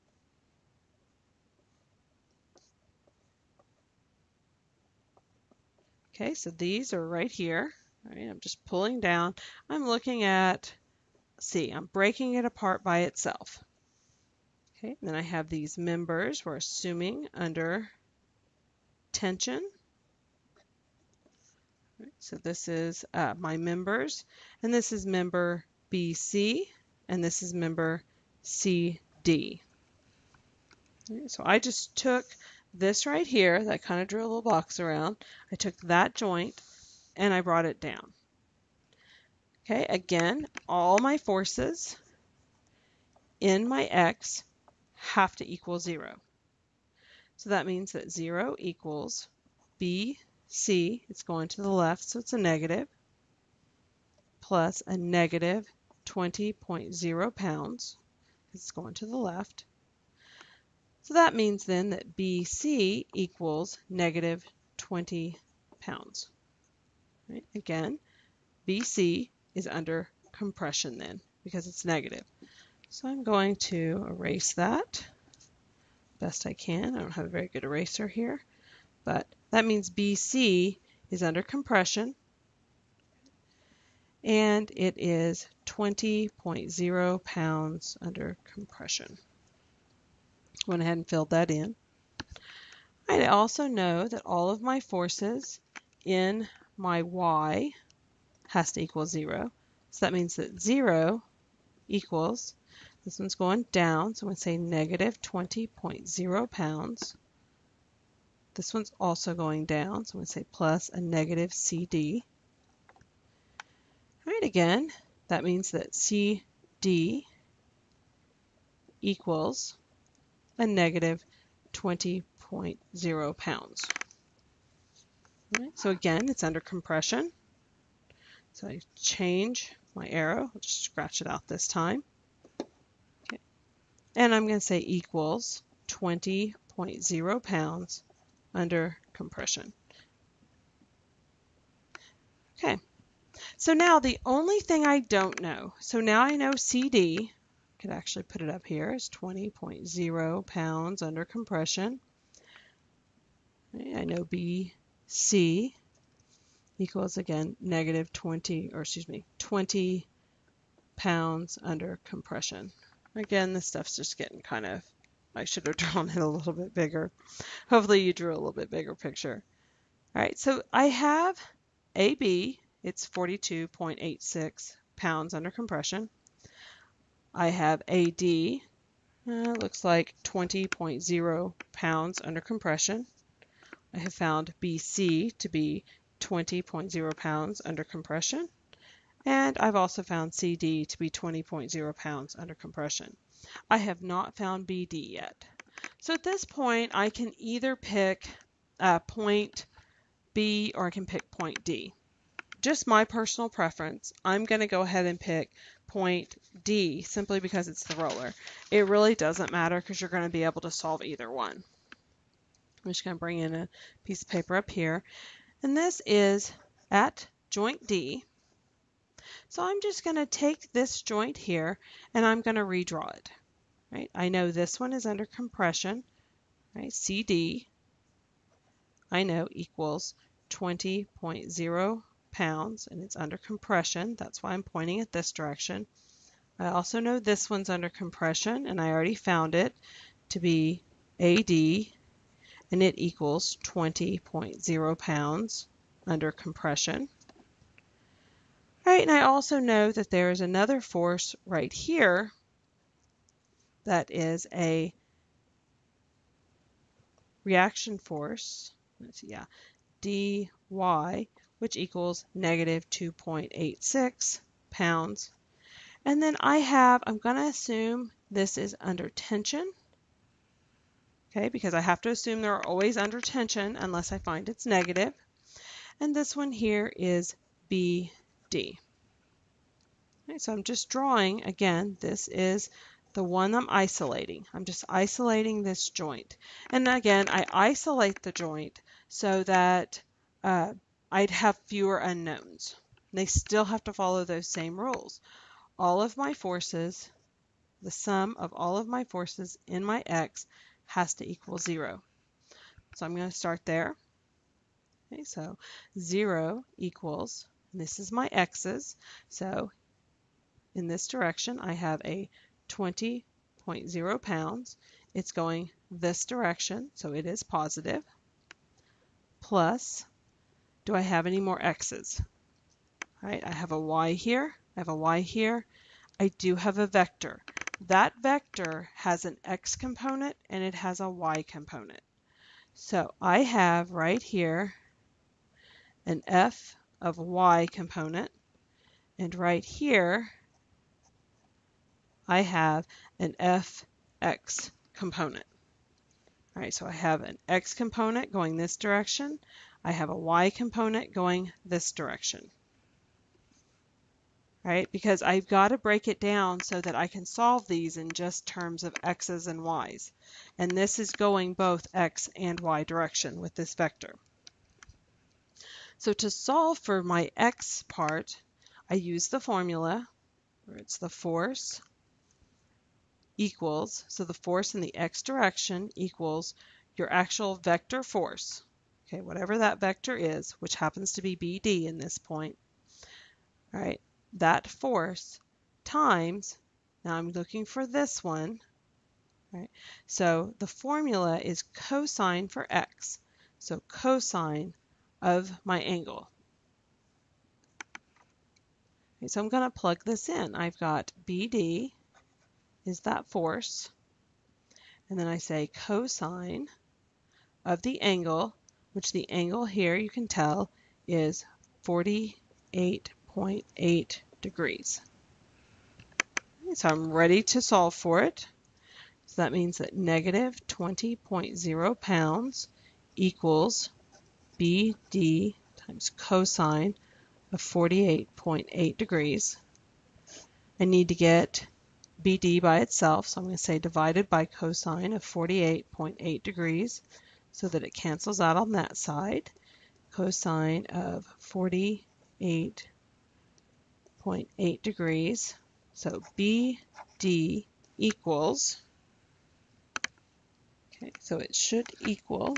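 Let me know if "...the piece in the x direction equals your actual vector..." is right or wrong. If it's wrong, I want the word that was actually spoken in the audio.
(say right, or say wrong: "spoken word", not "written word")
wrong: "force", not "piece".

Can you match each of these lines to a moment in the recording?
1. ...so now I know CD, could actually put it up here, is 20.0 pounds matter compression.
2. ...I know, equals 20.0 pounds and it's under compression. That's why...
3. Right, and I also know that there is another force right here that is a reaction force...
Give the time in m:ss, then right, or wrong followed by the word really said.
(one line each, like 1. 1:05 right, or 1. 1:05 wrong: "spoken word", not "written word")
1. 2:25 wrong: "under", not "matter"
2. 3:49 right
3. 4:08 right.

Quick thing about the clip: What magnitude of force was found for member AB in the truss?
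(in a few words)
42.86 pounds.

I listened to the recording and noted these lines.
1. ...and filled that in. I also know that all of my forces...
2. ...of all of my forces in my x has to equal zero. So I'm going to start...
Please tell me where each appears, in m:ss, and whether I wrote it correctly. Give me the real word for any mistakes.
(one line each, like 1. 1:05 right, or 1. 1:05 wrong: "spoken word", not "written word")
1. 1:30 right
2. 4:58 right.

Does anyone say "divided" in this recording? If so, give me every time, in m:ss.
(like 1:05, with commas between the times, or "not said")
7:13.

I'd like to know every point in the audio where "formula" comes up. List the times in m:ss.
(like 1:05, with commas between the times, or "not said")
6:09, 6:30.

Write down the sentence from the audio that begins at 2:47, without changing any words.
Hopefully you drew a little bit bigger picture.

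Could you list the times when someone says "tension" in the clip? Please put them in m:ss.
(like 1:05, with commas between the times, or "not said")
0:19, 4:29, 4:33.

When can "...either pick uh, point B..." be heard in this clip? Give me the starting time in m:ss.
3:17.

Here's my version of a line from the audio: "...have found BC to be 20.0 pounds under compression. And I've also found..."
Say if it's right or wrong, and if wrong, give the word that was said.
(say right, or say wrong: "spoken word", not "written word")
right.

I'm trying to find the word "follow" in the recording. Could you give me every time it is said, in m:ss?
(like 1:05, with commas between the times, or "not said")
4:53.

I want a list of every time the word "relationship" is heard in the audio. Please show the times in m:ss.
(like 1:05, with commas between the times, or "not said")
not said.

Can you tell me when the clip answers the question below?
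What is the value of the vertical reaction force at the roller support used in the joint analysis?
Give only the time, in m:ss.
4:22.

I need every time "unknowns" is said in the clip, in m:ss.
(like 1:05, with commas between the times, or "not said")
4:51.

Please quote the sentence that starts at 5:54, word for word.
All right, because I've got to break it down so that I can solve these in just terms of x's and y's.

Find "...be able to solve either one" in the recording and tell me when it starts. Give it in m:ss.
3:30.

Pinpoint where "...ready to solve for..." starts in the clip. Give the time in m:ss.
6:57.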